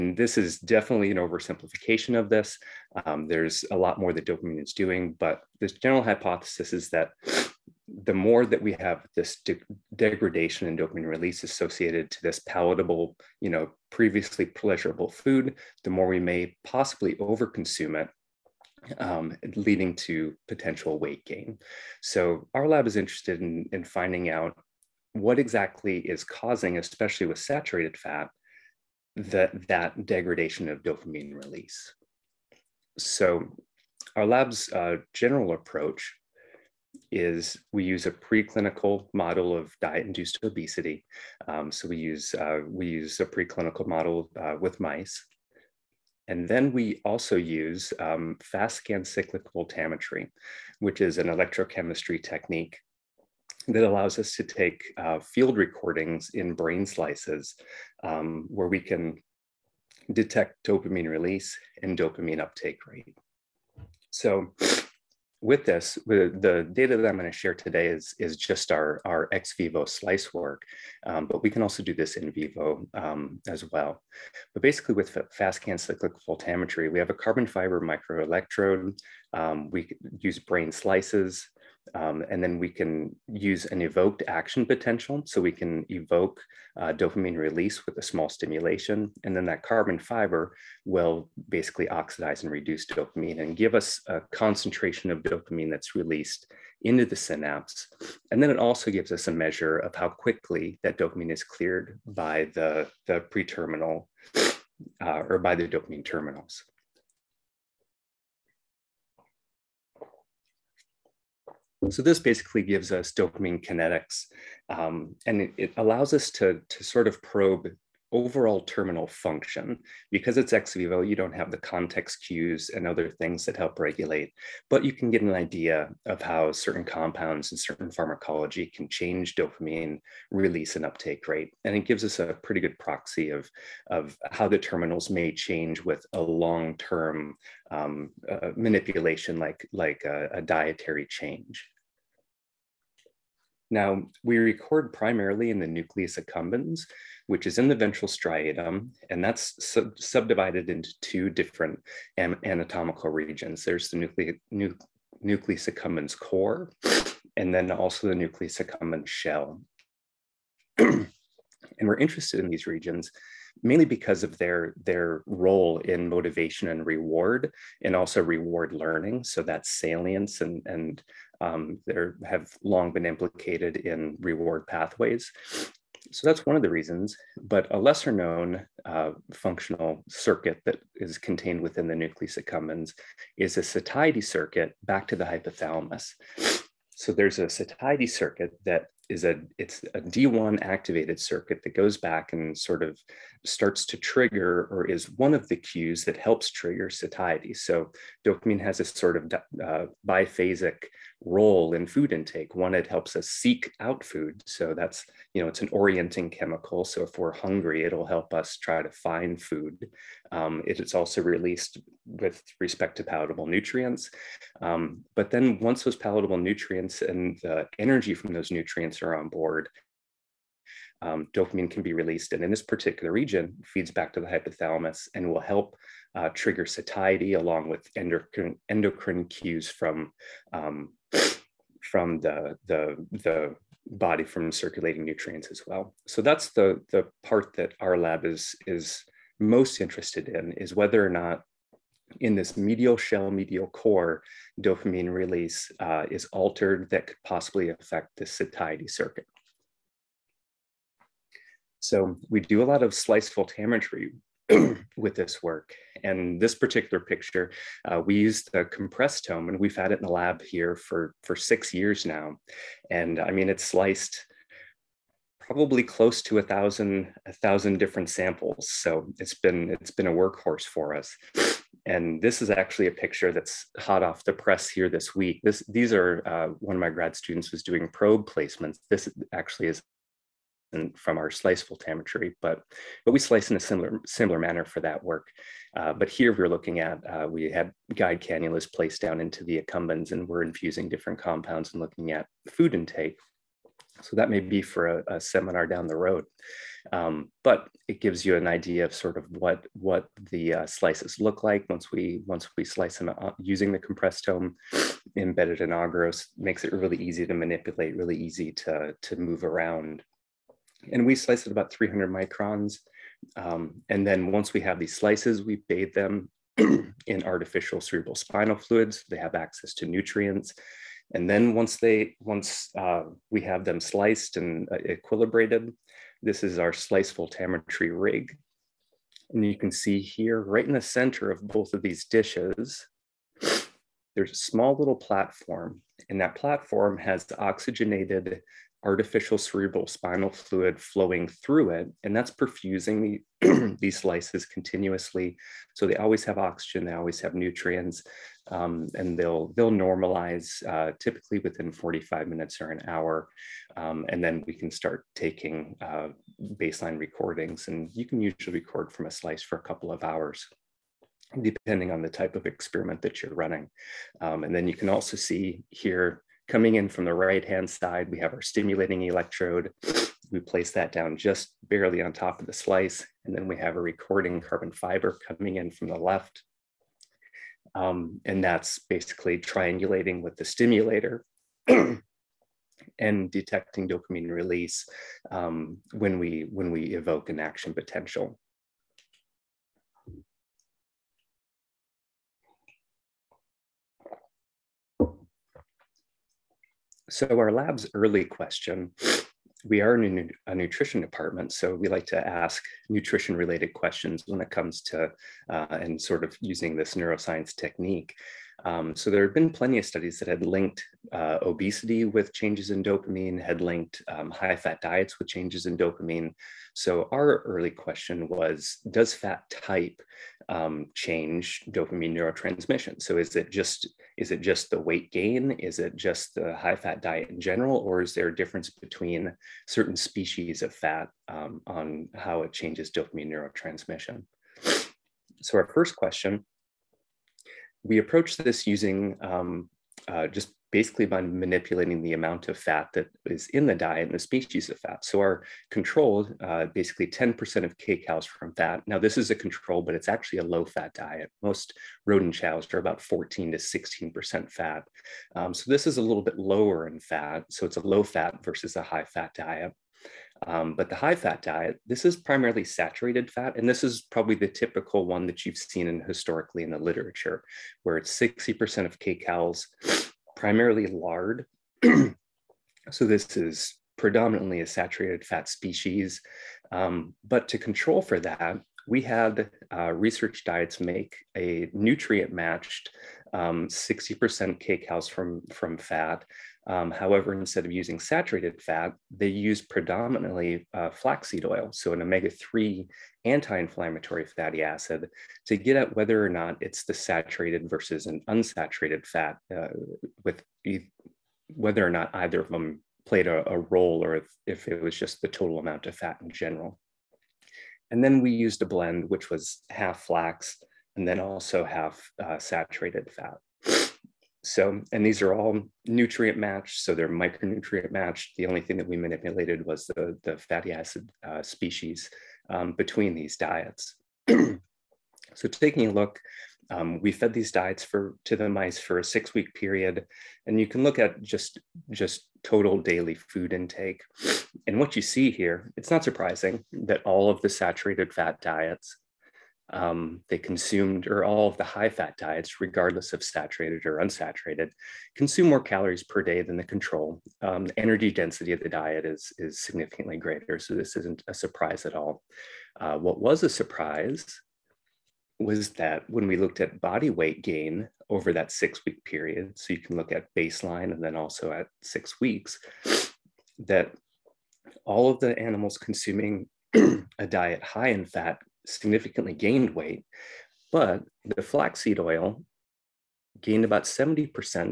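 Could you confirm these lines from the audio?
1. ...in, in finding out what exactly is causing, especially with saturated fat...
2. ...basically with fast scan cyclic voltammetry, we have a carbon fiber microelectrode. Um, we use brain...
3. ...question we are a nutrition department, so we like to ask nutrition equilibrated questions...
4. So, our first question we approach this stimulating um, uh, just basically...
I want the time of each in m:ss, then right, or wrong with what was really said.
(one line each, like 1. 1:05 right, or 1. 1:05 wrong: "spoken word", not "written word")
1. 0:23 right
2. 1:14 right
3. 6:38 wrong: "related", not "equilibrated"
4. 7:15 wrong: "using", not "stimulating".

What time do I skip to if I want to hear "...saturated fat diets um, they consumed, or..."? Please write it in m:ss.
8:57.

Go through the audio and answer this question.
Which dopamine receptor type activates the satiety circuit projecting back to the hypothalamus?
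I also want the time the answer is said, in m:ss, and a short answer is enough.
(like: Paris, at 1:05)
D1, at 3:09.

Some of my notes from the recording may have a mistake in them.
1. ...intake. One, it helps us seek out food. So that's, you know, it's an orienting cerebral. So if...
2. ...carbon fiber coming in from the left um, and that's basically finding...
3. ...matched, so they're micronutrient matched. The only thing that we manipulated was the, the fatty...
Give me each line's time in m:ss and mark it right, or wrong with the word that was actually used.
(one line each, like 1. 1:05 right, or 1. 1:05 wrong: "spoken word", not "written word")
1. 3:22 wrong: "chemical", not "cerebral"
2. 6:14 wrong: "triangulating", not "finding"
3. 8:36 right.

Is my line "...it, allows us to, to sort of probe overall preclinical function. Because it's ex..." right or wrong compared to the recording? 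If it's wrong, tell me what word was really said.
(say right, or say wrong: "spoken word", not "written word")
wrong: "terminal", not "preclinical".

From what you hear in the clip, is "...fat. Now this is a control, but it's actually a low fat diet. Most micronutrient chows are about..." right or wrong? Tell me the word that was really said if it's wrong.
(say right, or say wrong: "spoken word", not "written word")
wrong: "rodent", not "micronutrient".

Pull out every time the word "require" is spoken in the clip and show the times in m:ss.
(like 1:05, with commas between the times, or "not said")
not said.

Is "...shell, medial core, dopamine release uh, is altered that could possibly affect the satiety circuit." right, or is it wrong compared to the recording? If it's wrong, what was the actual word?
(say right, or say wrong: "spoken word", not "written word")
right.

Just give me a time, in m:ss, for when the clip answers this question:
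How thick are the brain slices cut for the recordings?
5:11.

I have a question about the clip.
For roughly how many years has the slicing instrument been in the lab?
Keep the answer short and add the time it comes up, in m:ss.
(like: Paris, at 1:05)
6 years, at 4:21.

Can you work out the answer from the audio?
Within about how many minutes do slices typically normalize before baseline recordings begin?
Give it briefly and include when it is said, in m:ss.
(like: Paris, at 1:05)
45 minutes, at 5:51.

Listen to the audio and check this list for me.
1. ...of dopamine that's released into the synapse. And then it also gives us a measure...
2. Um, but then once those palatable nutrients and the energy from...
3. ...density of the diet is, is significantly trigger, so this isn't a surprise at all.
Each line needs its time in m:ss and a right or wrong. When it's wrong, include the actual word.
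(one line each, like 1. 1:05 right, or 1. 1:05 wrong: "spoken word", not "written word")
1. 1:35 right
2. 3:34 right
3. 9:08 wrong: "greater", not "trigger".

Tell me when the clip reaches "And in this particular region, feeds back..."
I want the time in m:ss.
3:42.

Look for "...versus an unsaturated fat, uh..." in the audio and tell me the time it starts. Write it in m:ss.
8:17.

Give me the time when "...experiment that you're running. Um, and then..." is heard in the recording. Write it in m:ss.
6:02.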